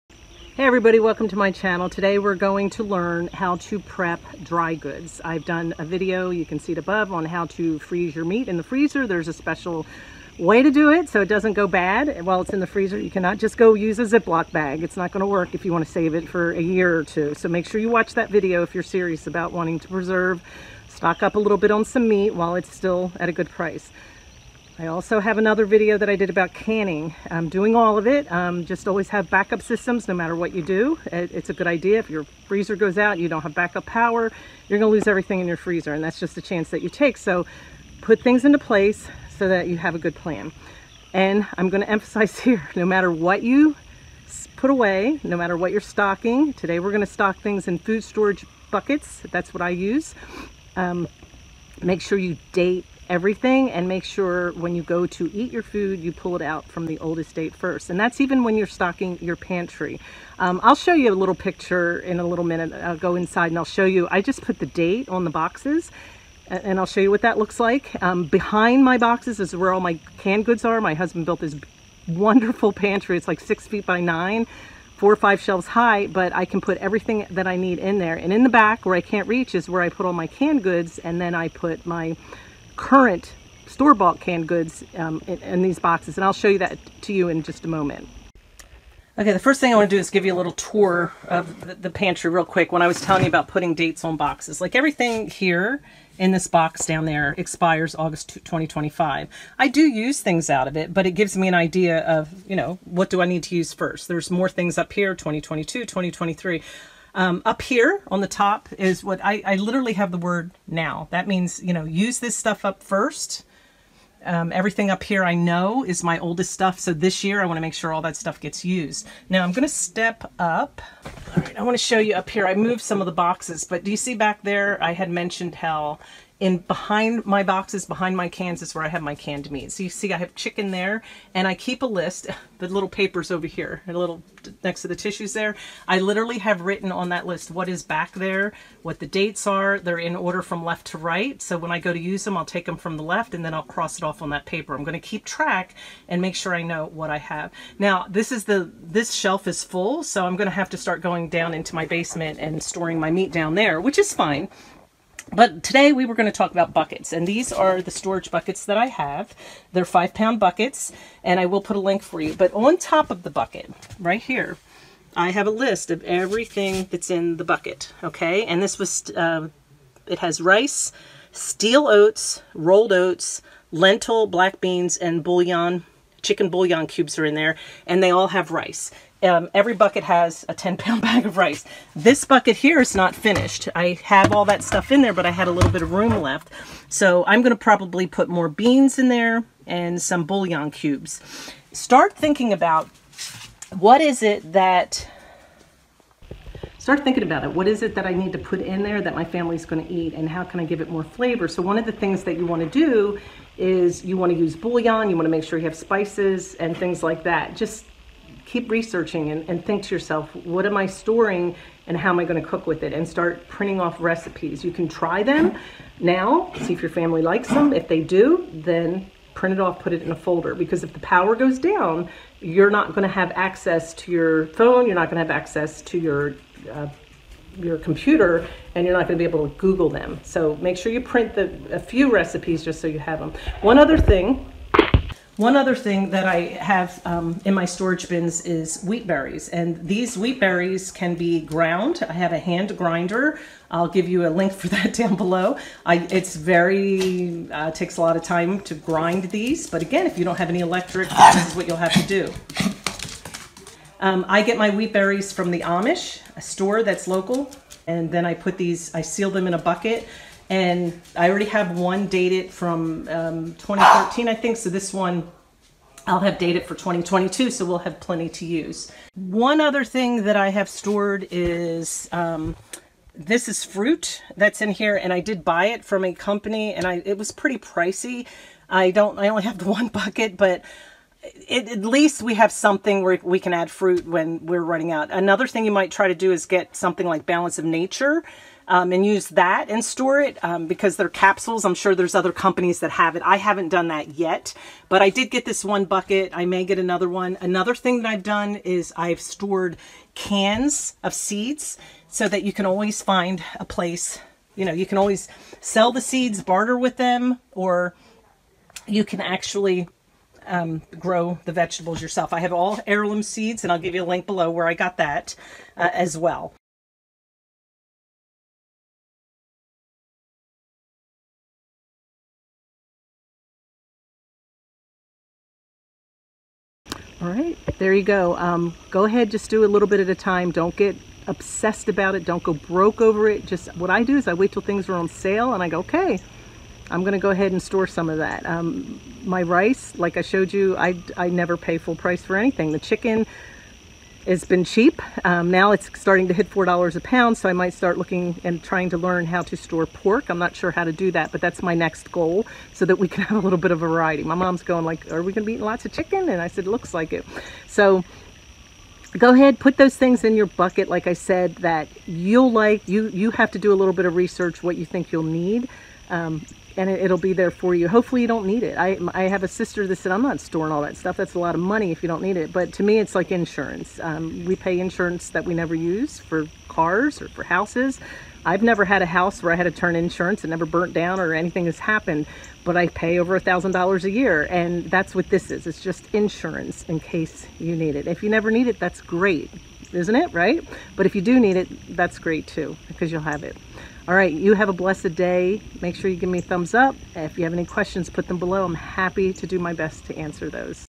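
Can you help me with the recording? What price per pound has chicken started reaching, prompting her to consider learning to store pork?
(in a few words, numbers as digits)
$4.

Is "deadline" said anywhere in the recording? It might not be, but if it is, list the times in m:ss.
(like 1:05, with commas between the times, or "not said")
not said.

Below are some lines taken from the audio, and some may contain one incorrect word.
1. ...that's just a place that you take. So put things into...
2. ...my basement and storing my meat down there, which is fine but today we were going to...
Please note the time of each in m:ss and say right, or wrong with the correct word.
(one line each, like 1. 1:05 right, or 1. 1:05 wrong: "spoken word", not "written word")
1. 0:36 wrong: "chance", not "place"
2. 2:31 right.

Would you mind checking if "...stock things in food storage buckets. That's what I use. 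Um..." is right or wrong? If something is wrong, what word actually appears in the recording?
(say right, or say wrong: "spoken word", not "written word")
right.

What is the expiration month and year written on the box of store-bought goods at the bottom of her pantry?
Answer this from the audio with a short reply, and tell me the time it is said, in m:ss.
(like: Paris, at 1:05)
August 2025, at 1:37.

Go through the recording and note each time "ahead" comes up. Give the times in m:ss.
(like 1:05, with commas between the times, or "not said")
5:29, 5:37, 5:59.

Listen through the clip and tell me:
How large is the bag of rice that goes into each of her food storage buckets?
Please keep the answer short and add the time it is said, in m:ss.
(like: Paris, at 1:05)
10 pound, at 3:00.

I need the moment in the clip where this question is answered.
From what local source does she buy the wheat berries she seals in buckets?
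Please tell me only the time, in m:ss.
4:15.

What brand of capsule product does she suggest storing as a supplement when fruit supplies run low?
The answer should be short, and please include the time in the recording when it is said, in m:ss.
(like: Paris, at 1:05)
Balance of Nature, at 4:47.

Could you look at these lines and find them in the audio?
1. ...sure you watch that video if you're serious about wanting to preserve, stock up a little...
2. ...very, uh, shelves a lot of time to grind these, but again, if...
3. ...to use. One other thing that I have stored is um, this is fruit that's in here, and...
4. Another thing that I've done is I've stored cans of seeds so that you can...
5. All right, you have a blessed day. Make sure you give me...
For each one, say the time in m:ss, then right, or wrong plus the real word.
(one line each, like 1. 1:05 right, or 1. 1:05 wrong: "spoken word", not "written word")
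1. 0:17 right
2. 4:06 wrong: "takes", not "shelves"
3. 4:28 right
4. 4:57 right
5. 6:34 right.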